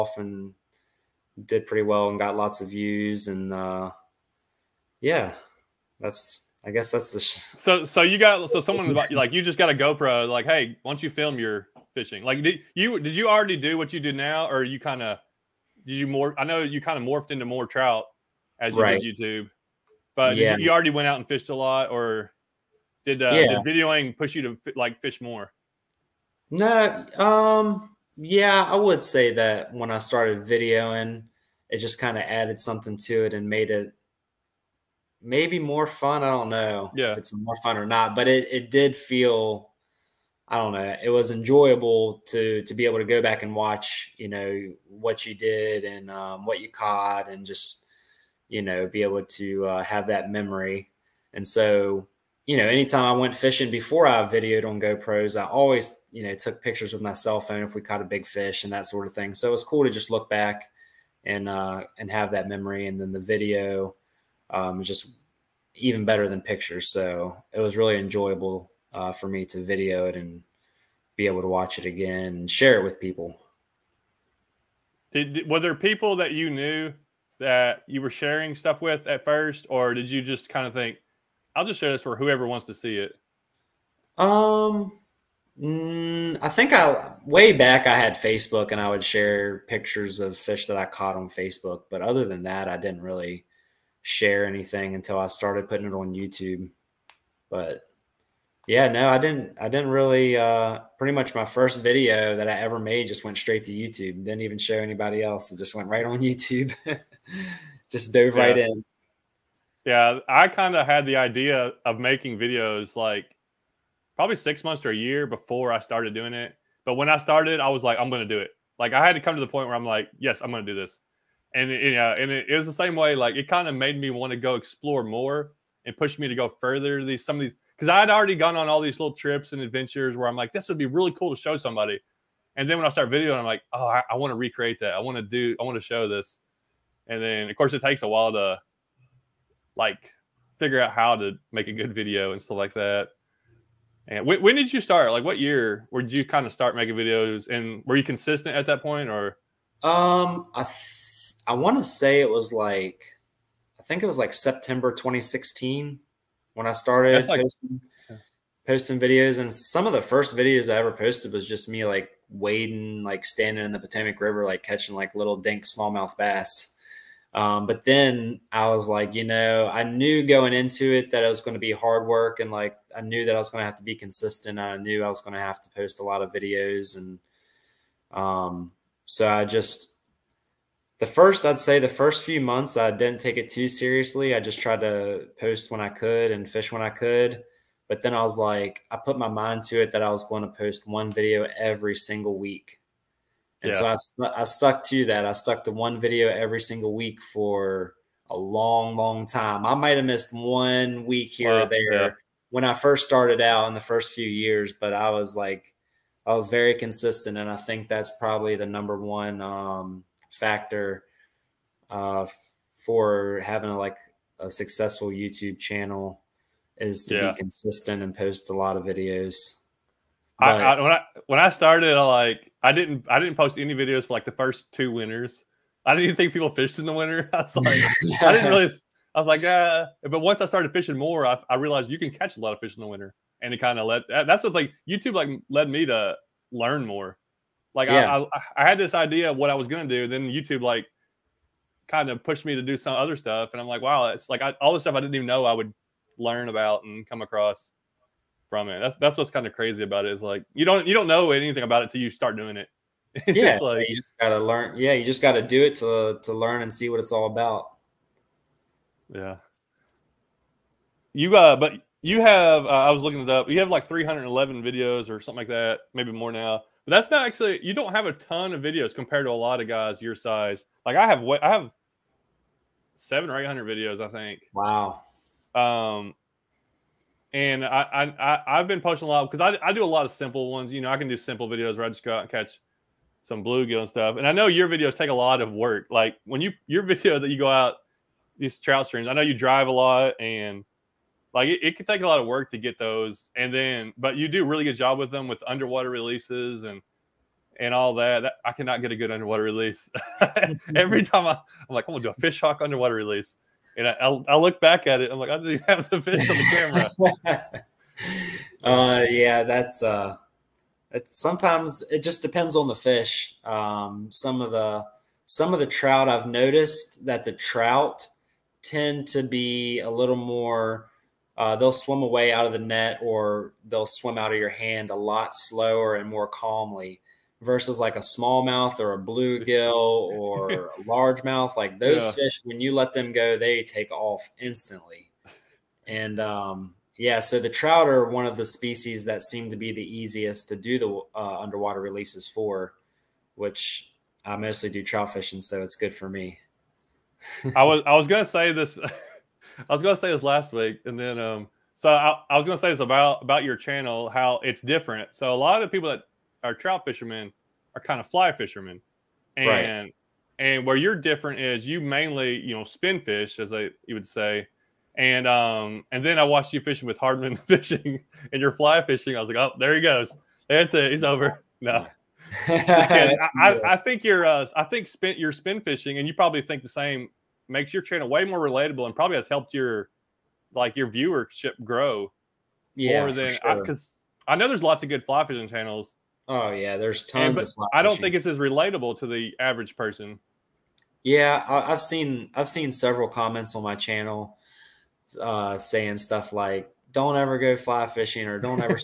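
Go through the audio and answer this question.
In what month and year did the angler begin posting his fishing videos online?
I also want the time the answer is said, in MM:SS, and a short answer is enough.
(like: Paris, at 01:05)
September 2016, at 02:34.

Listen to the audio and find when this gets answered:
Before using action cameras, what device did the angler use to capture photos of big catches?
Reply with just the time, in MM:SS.
00:57.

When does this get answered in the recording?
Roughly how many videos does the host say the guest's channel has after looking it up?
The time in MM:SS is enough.
04:23.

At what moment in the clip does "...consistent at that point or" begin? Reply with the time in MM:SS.
02:28.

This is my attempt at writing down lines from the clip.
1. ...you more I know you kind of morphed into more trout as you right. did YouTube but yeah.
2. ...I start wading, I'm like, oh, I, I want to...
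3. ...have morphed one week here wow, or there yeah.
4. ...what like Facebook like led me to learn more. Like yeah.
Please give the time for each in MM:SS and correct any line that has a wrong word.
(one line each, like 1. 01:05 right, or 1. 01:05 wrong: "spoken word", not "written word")
1. 00:15 right
2. 02:12 wrong: "videoing", not "wading"
3. 03:19 wrong: "missed", not "morphed"
4. 03:54 wrong: "YouTube", not "Facebook".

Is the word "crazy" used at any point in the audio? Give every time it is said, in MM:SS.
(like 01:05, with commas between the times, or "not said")
04:09.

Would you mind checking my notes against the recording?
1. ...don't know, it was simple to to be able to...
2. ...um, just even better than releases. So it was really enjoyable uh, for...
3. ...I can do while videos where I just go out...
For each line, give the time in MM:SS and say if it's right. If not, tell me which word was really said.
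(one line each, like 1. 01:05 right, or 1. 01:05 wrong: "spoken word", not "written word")
1. 00:40 wrong: "enjoyable", not "simple"
2. 01:04 wrong: "pictures", not "releases"
3. 04:40 wrong: "simple", not "while".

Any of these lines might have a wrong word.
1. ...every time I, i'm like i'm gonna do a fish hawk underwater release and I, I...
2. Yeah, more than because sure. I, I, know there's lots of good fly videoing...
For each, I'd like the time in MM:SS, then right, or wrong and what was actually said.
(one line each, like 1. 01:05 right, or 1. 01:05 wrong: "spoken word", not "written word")
1. 05:00 right
2. 06:22 wrong: "fishing", not "videoing".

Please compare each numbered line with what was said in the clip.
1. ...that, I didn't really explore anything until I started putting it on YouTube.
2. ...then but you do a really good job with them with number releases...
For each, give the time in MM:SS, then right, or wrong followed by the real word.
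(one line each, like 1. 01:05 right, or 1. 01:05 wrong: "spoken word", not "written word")
1. 01:32 wrong: "share", not "explore"
2. 04:53 wrong: "underwater", not "number".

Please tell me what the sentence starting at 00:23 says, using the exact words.
did videoing push you to like fish more?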